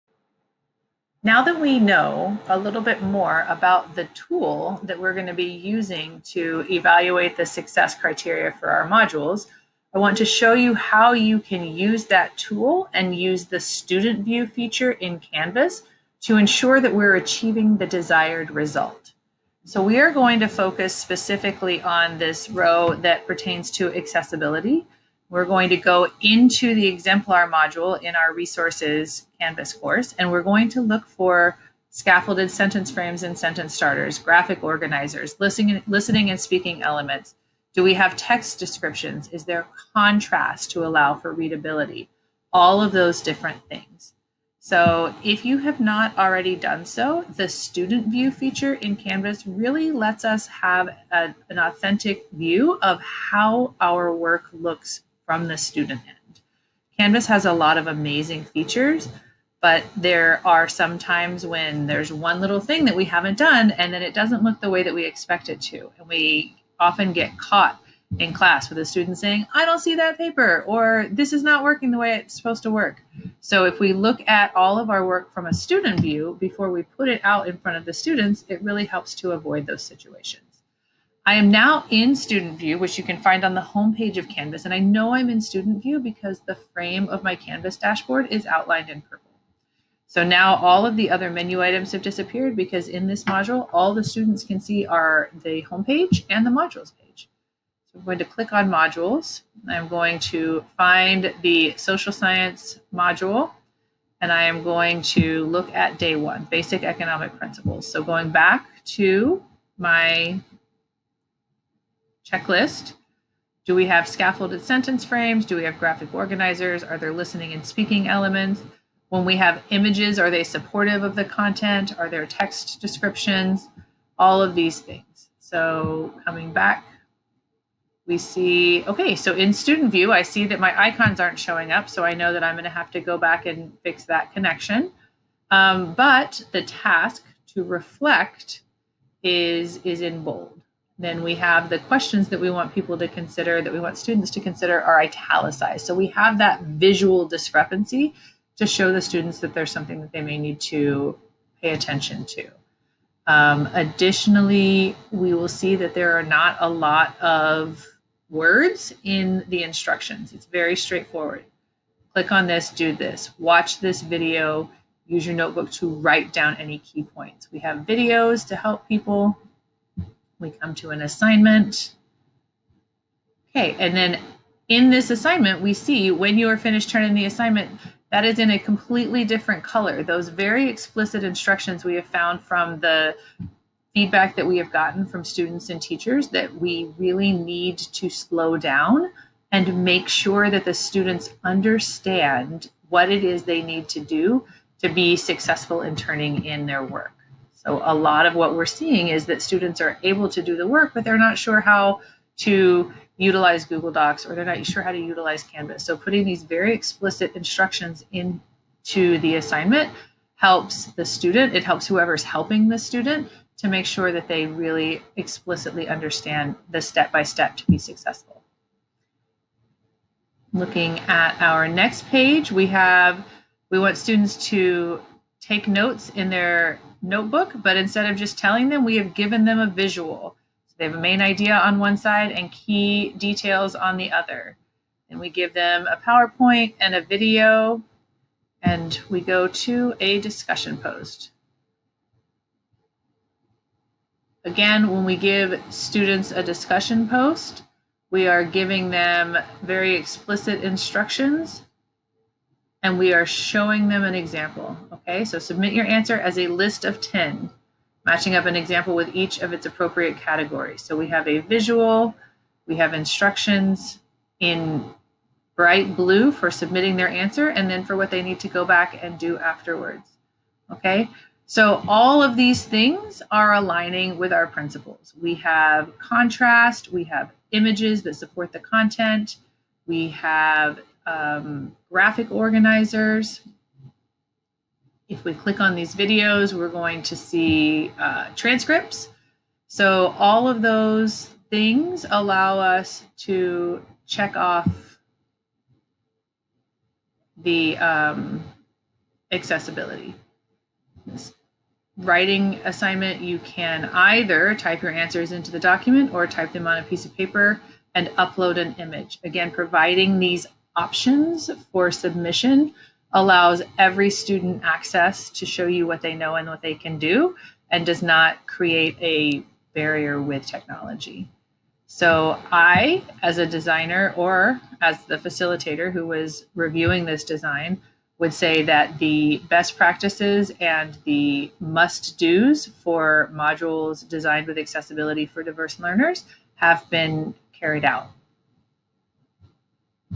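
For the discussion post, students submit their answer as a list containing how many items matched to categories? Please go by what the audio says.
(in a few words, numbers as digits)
10.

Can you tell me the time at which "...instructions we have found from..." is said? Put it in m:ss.
3:01.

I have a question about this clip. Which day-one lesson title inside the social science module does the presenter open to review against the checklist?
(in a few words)
basic economic principles.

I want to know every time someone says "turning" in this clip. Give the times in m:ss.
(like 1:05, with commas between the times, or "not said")
2:56, 3:15.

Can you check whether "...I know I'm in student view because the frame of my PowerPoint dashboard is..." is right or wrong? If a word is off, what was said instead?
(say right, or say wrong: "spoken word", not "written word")
wrong: "Canvas", not "PowerPoint".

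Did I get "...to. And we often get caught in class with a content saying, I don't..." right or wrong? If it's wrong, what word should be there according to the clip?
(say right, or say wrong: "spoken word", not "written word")
wrong: "student", not "content".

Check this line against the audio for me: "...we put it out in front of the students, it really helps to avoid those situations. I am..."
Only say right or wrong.
right.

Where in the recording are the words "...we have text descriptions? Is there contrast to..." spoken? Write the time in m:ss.
0:37.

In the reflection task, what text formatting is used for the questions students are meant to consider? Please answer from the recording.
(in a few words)
italicized.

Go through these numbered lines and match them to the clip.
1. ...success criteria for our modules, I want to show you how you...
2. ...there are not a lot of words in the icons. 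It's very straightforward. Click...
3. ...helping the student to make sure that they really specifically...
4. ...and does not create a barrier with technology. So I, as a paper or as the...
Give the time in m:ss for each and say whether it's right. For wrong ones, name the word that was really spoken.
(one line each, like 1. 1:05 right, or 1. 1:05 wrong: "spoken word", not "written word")
1. 0:07 right
2. 2:35 wrong: "instructions", not "icons"
3. 3:32 wrong: "explicitly", not "specifically"
4. 5:17 wrong: "designer", not "paper".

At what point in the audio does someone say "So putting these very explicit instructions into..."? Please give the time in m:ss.
3:25.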